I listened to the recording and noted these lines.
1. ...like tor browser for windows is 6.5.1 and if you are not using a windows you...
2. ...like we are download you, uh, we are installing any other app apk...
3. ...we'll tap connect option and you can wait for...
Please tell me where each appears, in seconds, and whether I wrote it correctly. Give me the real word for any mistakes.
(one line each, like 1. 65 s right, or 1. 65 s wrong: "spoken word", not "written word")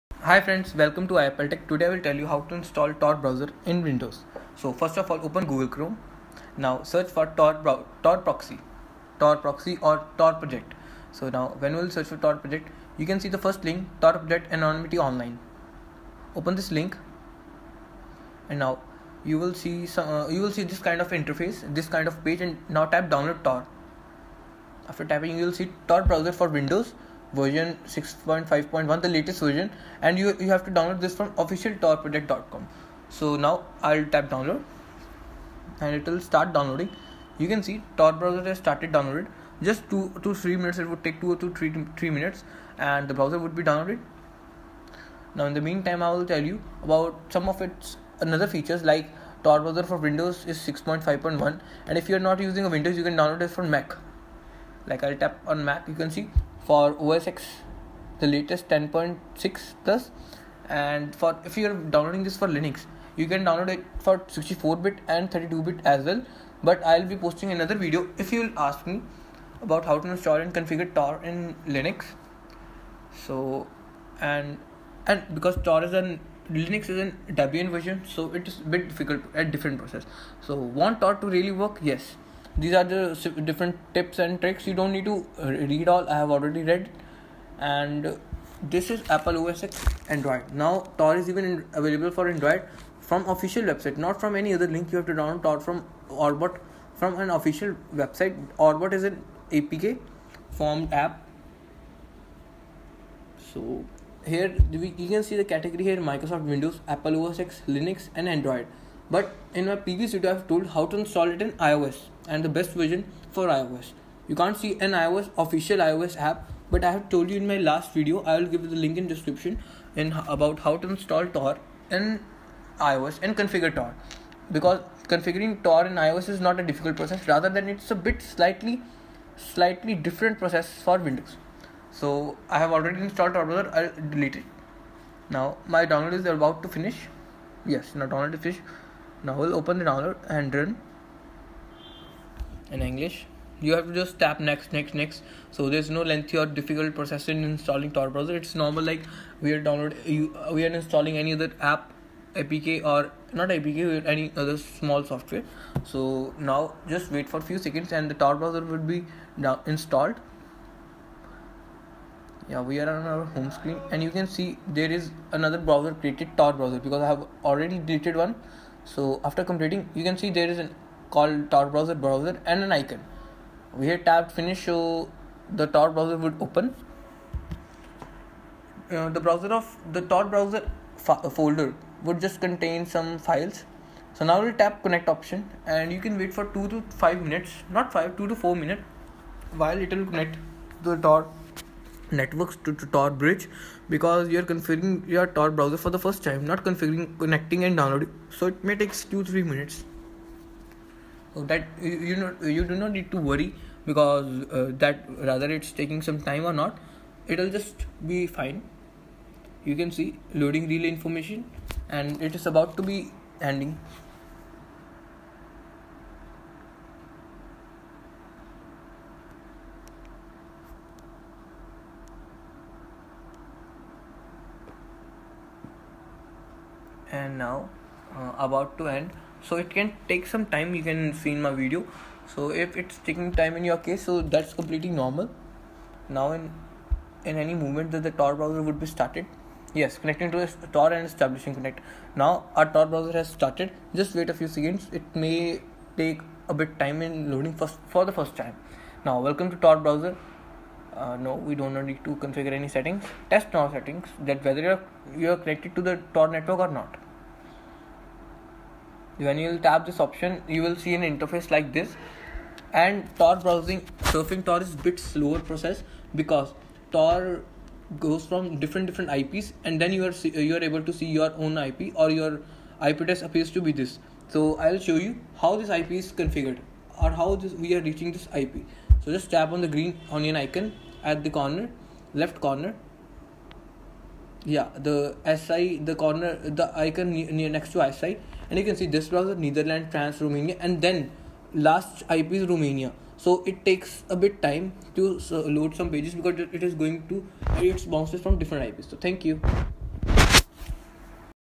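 1. 48 s right
2. 148 s right
3. 184 s right.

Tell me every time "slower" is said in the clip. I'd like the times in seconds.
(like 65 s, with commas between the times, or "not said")
264 s.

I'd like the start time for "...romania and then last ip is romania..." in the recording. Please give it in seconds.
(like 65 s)
290 s.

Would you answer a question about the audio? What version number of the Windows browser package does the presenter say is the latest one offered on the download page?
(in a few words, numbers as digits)
6.5.1.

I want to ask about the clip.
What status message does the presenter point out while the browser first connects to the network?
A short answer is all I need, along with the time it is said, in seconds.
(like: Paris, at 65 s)
loading relay information, at 210 s.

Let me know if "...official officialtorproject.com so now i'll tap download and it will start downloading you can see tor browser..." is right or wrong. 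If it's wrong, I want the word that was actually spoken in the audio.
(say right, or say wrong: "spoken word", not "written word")
right.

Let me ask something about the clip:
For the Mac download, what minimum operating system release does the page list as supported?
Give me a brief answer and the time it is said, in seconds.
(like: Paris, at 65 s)
10.6 plus, at 58 s.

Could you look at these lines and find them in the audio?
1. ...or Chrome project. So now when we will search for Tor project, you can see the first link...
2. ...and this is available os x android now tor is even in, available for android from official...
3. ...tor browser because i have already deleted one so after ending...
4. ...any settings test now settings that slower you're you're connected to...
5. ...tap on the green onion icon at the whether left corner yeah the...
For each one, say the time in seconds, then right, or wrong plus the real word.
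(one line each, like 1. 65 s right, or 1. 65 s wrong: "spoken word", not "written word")
1. 9 s wrong: "Tor", not "Chrome"
2. 87 s wrong: "apple", not "available"
3. 166 s wrong: "completing", not "ending"
4. 252 s wrong: "whether", not "slower"
5. 279 s wrong: "corner", not "whether".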